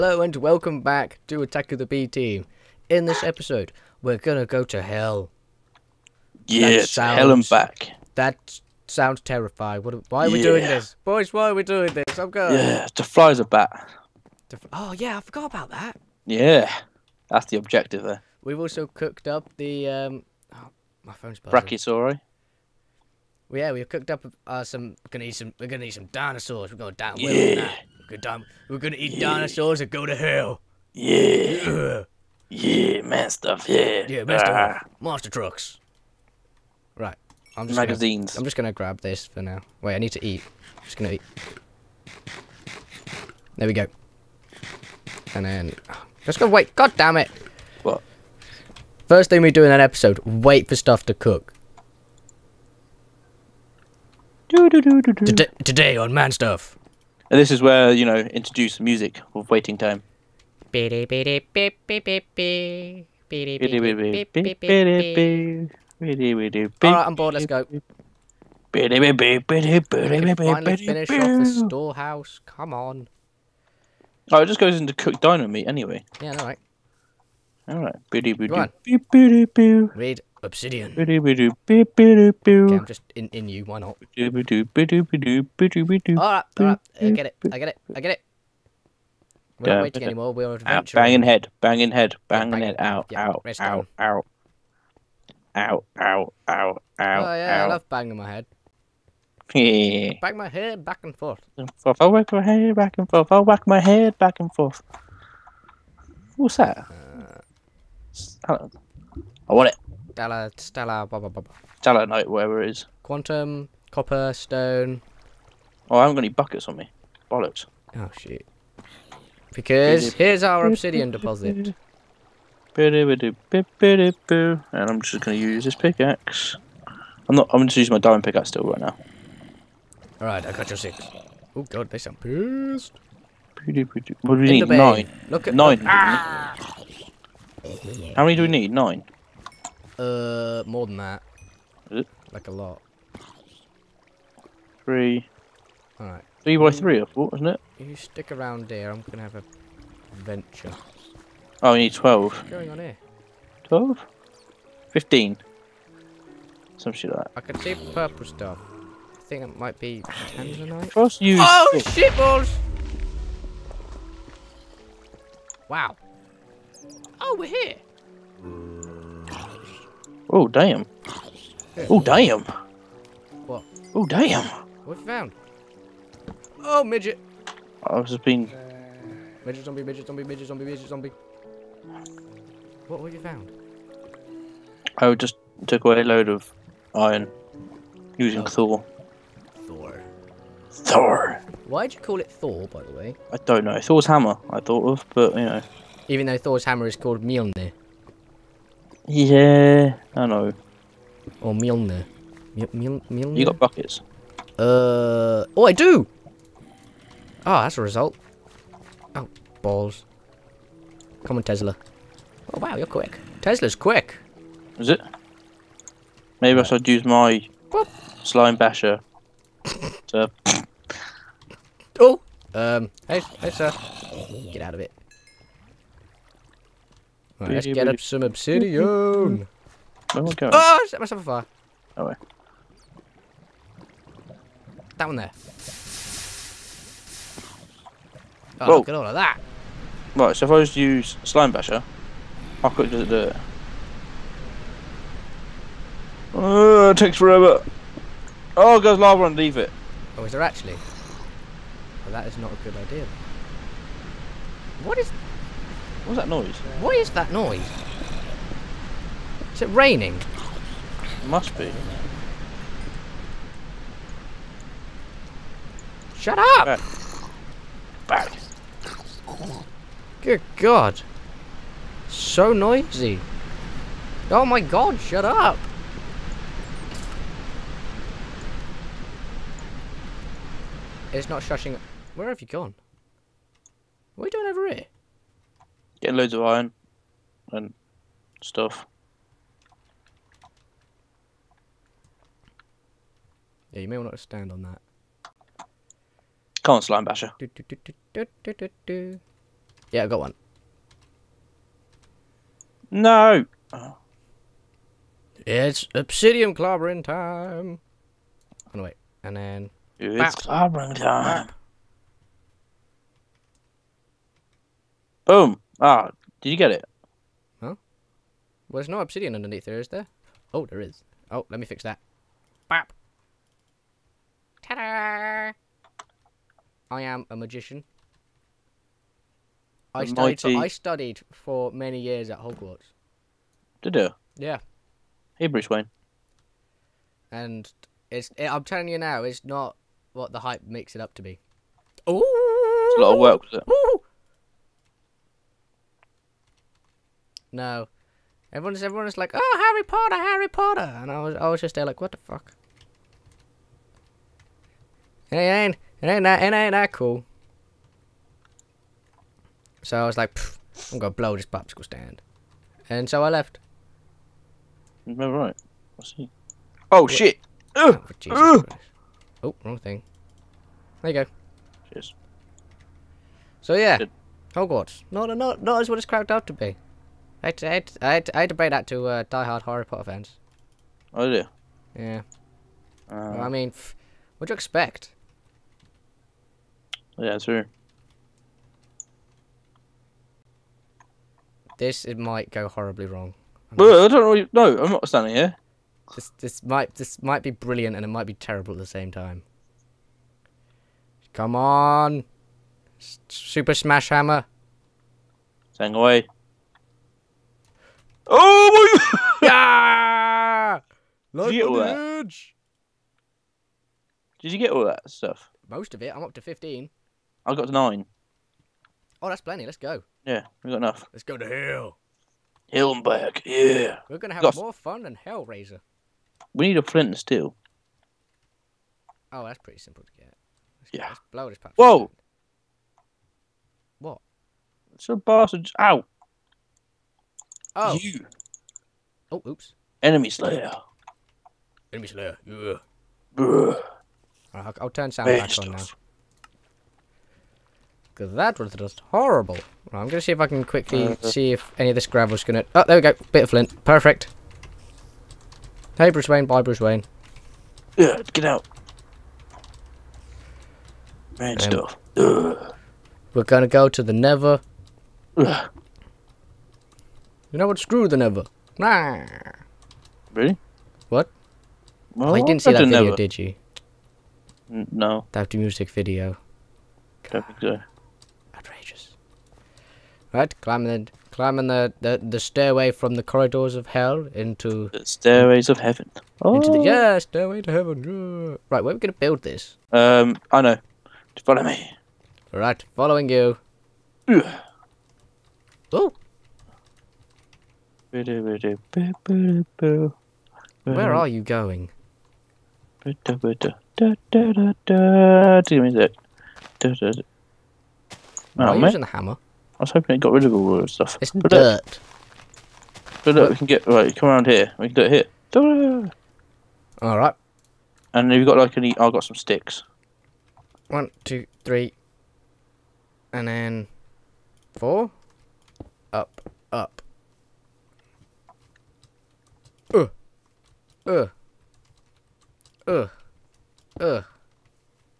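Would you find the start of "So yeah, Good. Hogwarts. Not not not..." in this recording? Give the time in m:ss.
6:13.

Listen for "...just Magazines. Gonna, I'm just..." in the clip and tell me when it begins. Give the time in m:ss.
0:37.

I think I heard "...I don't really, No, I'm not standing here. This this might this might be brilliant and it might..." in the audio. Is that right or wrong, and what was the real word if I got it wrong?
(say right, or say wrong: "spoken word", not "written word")
right.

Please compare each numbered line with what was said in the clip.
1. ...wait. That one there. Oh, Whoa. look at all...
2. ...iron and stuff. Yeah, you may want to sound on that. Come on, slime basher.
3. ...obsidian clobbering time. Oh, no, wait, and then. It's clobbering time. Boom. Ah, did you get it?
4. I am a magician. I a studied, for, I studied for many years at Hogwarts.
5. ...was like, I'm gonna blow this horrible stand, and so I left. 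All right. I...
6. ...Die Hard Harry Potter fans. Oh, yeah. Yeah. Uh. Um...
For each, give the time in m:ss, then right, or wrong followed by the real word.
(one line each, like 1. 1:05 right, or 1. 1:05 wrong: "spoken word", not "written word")
1. 3:52 right
2. 4:46 wrong: "stand", not "sound"
3. 5:05 right
4. 5:26 right
5. 6:00 wrong: "popsicle", not "horrible"
6. 6:19 right.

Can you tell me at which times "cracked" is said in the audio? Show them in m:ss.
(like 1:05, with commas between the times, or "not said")
6:16.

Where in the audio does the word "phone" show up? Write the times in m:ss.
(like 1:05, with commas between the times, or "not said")
0:21.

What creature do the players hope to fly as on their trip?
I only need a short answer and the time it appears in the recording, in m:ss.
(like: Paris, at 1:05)
A bat, at 0:13.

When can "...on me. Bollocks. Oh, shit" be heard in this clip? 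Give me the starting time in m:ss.
1:56.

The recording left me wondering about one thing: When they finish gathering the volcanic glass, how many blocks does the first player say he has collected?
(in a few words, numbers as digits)
15.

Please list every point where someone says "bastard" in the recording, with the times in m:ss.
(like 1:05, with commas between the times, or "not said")
7:15.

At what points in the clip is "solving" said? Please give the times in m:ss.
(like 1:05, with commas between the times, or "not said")
not said.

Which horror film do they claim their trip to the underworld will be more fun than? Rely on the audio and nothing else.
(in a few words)
Hellraiser.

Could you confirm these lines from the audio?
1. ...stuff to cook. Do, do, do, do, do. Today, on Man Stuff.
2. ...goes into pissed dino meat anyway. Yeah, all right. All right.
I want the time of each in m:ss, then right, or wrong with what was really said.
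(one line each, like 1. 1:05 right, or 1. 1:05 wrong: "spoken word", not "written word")
1. 0:50 right
2. 1:14 wrong: "cooked", not "pissed".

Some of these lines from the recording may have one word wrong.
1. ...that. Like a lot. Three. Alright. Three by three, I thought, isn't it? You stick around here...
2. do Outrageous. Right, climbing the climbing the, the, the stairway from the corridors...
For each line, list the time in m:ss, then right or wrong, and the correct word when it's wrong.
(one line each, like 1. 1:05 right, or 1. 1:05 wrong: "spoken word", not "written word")
1. 2:20 right
2. 7:57 right.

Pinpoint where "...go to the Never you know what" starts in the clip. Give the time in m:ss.
7:43.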